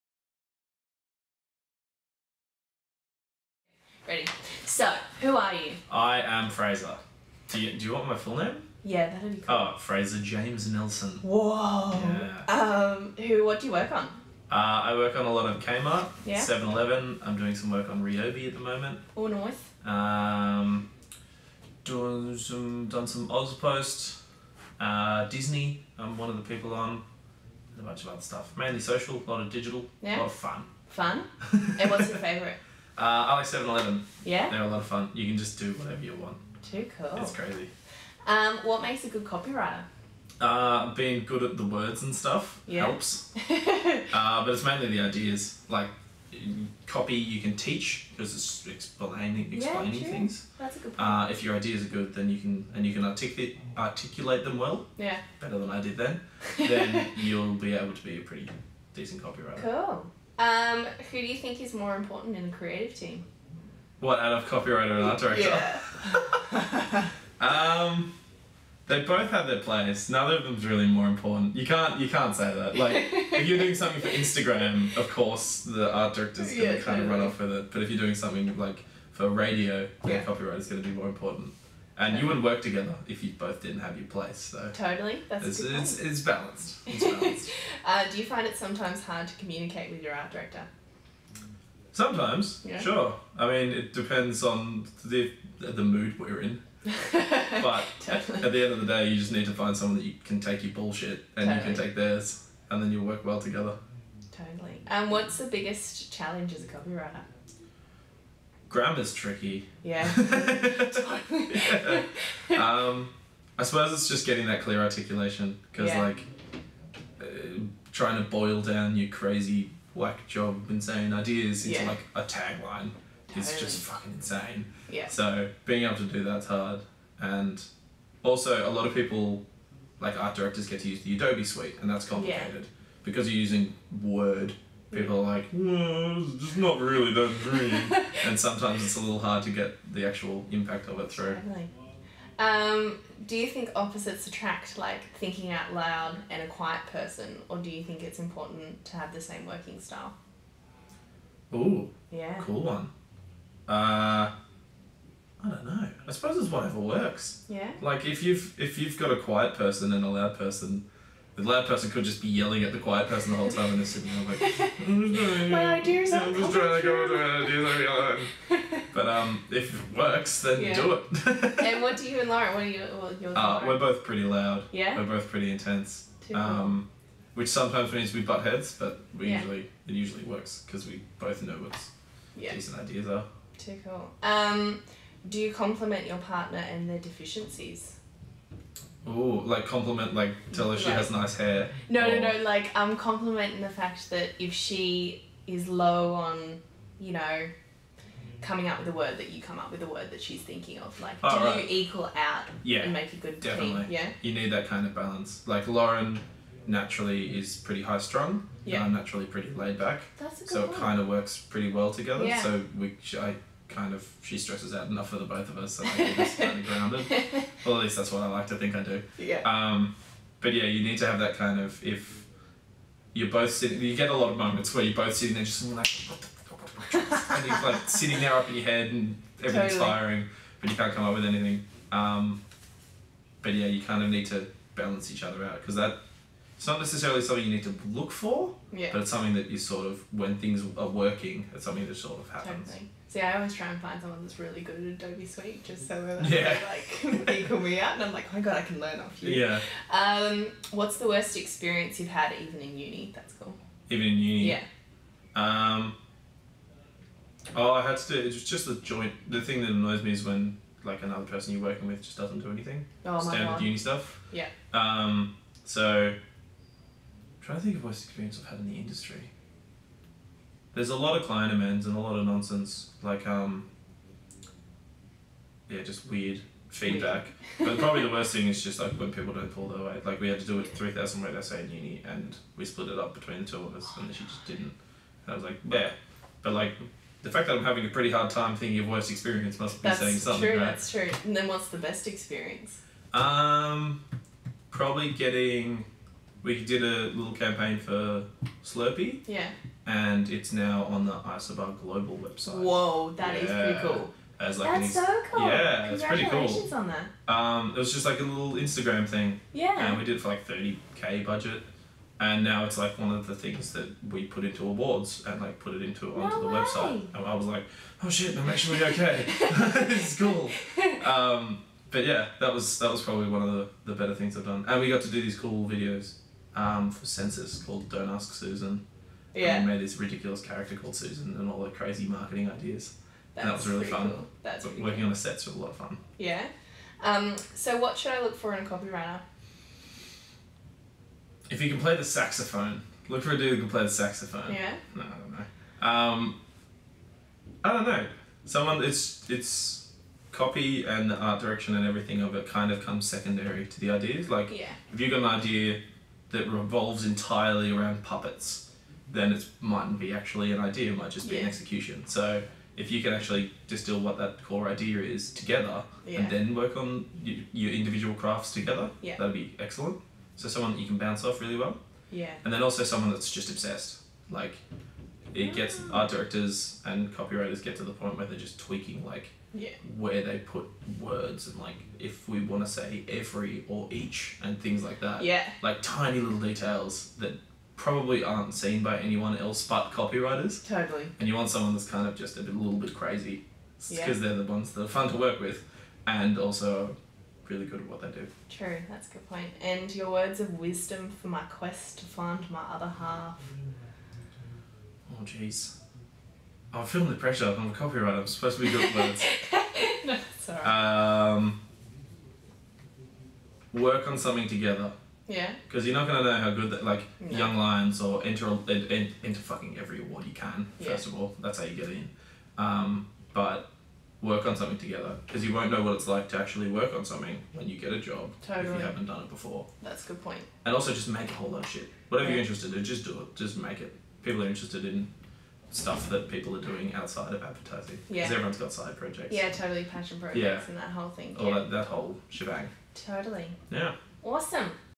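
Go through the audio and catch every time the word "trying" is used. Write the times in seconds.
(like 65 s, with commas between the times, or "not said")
117 s, 166 s, 267 s.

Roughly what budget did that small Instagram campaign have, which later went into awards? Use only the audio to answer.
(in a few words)
30k.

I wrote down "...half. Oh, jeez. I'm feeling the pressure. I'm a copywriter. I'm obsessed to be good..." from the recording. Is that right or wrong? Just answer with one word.
wrong.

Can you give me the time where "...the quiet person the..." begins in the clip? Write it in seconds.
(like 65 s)
162 s.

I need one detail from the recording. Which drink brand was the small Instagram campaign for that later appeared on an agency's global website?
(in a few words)
Slurpee.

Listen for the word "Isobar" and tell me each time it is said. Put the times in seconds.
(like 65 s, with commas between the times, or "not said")
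301 s.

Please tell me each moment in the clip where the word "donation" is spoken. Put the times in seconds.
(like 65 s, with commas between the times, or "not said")
not said.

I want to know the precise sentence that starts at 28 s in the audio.
Mainly social, a lot of digital, yeah.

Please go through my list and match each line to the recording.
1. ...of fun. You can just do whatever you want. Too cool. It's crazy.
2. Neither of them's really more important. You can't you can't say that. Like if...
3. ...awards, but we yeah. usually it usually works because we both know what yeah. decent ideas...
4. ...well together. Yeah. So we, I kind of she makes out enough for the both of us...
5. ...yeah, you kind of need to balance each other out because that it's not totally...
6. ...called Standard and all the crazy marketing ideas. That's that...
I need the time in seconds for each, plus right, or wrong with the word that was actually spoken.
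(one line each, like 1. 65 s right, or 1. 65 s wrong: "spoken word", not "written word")
1. 34 s right
2. 70 s right
3. 178 s wrong: "heads", not "awards"
4. 211 s wrong: "stresses", not "makes"
5. 233 s wrong: "necessarily", not "totally"
6. 330 s wrong: "Susan", not "Standard".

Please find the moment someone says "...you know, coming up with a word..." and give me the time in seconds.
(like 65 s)
196 s.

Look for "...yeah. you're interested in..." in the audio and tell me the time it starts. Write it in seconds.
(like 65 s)
432 s.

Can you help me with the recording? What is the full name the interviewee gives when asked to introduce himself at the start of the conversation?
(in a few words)
Fraser James Nelson.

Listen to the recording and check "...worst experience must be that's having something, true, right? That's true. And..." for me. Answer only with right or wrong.
wrong.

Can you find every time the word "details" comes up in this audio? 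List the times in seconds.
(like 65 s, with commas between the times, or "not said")
386 s.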